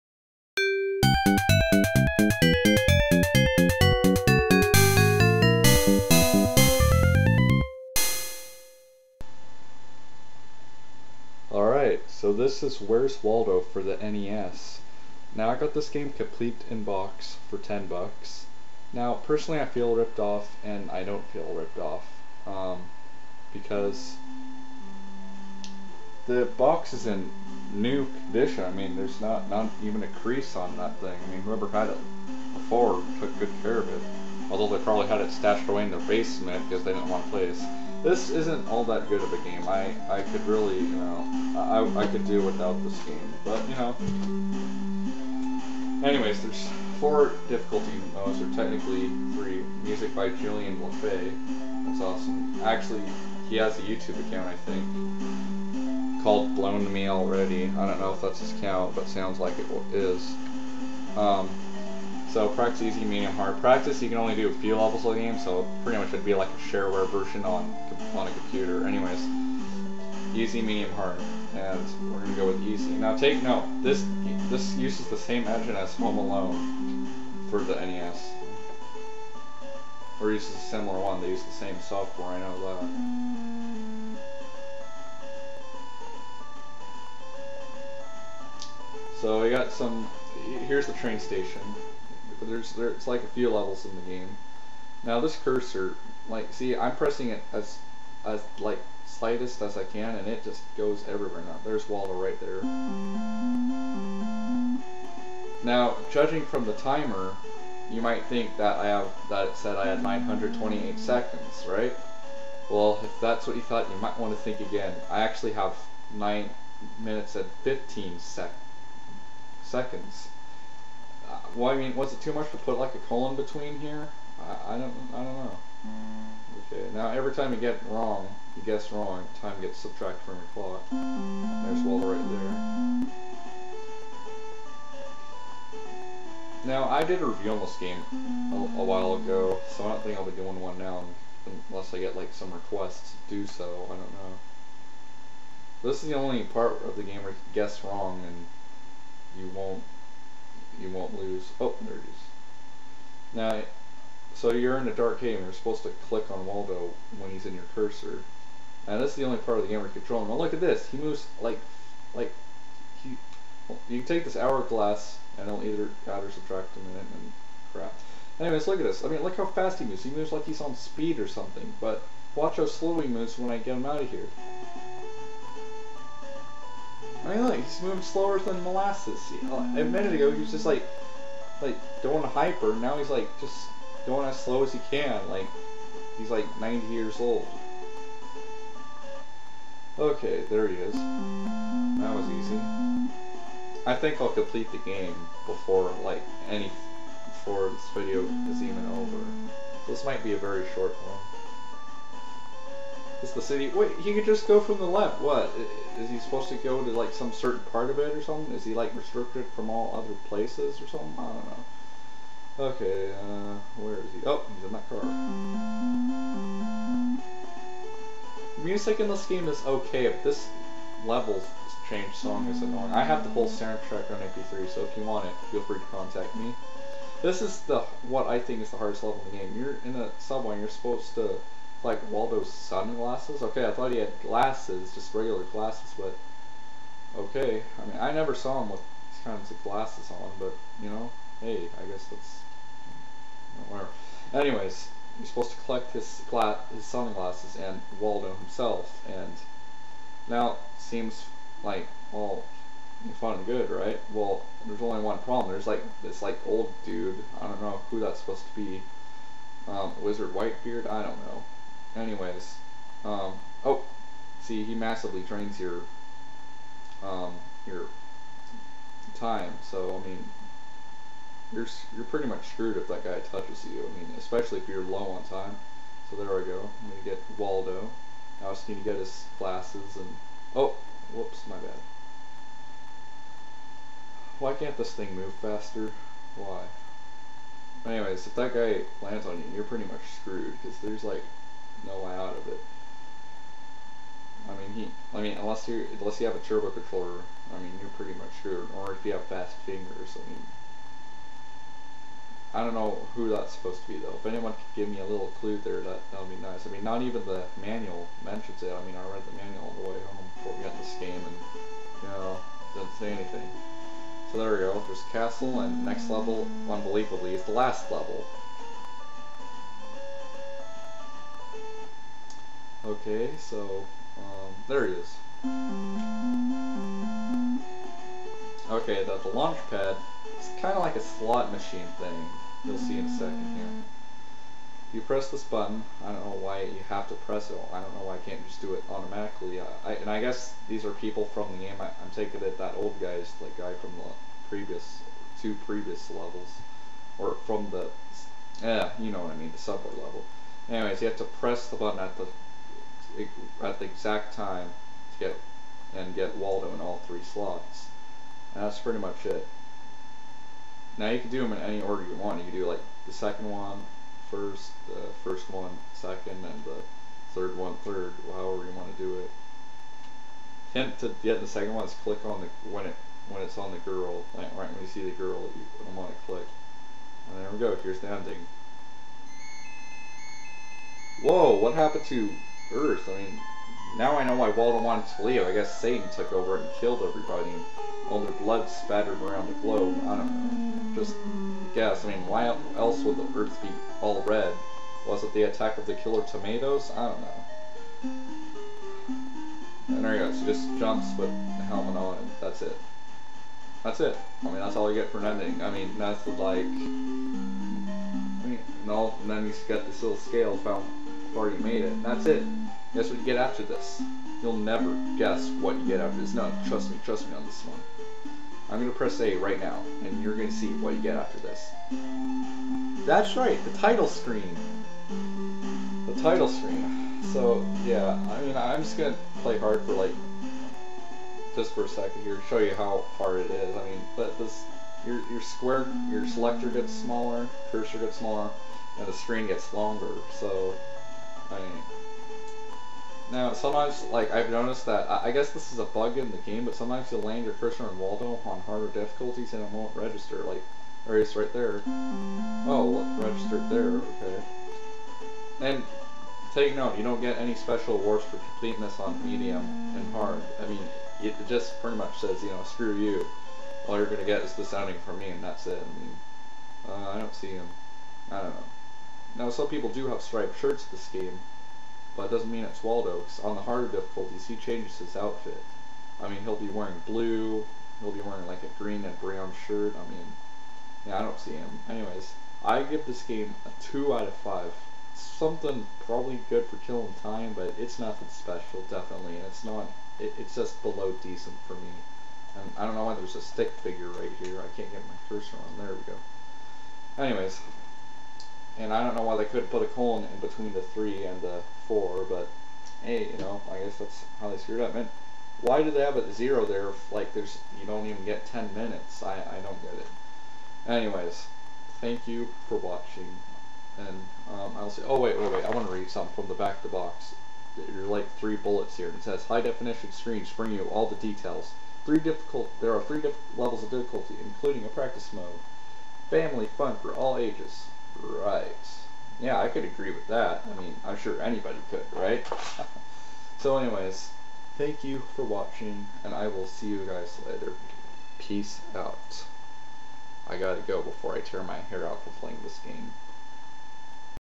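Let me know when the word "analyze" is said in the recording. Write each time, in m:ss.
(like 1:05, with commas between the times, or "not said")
not said.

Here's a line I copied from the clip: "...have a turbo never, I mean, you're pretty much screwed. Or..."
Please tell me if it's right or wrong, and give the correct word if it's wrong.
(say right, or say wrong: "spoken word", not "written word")
wrong: "controller", not "never".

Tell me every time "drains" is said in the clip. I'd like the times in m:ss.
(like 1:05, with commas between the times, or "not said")
4:25.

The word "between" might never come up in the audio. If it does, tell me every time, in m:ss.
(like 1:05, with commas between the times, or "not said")
2:03, 8:20.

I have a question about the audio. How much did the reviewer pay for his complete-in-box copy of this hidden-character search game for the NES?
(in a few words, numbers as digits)
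$10.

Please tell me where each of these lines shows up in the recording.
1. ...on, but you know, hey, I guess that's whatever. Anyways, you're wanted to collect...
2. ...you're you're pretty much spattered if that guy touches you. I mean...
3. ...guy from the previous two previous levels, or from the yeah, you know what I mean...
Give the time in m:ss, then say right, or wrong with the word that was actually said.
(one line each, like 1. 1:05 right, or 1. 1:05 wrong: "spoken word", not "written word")
1. 4:00 wrong: "supposed", not "wanted"
2. 4:31 wrong: "screwed", not "spattered"
3. 5:43 right.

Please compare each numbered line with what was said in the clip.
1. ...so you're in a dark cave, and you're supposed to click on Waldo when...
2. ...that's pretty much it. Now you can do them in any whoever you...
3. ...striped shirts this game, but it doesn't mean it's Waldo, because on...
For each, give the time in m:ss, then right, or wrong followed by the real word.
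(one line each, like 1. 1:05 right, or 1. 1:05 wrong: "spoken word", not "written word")
1. 2:34 right
2. 5:58 wrong: "order", not "whoever"
3. 7:50 right.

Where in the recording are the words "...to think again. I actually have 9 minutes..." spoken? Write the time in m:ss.
1:54.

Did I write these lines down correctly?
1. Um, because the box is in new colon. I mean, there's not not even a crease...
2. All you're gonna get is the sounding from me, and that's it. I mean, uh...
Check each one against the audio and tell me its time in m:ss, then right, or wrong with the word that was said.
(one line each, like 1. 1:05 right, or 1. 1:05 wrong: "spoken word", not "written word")
1. 0:22 wrong: "condition", not "colon"
2. 7:43 right.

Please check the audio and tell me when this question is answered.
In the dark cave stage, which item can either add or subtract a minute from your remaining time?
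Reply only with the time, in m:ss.
2:44.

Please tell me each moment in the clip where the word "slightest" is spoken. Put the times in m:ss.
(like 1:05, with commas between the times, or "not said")
1:39.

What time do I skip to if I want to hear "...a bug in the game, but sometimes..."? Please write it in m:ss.
7:25.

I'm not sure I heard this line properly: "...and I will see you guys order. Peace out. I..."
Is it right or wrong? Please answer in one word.
wrong.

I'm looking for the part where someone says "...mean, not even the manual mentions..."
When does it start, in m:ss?
5:06.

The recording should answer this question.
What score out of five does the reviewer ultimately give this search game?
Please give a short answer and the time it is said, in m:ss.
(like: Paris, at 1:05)
2, at 8:03.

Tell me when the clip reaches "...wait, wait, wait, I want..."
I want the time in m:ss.
8:35.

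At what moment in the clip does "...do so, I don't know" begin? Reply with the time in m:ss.
2:23.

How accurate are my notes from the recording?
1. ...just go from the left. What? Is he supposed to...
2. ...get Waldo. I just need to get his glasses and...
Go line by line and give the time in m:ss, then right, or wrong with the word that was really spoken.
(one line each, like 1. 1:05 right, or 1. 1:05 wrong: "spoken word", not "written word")
1. 3:24 right
2. 4:37 right.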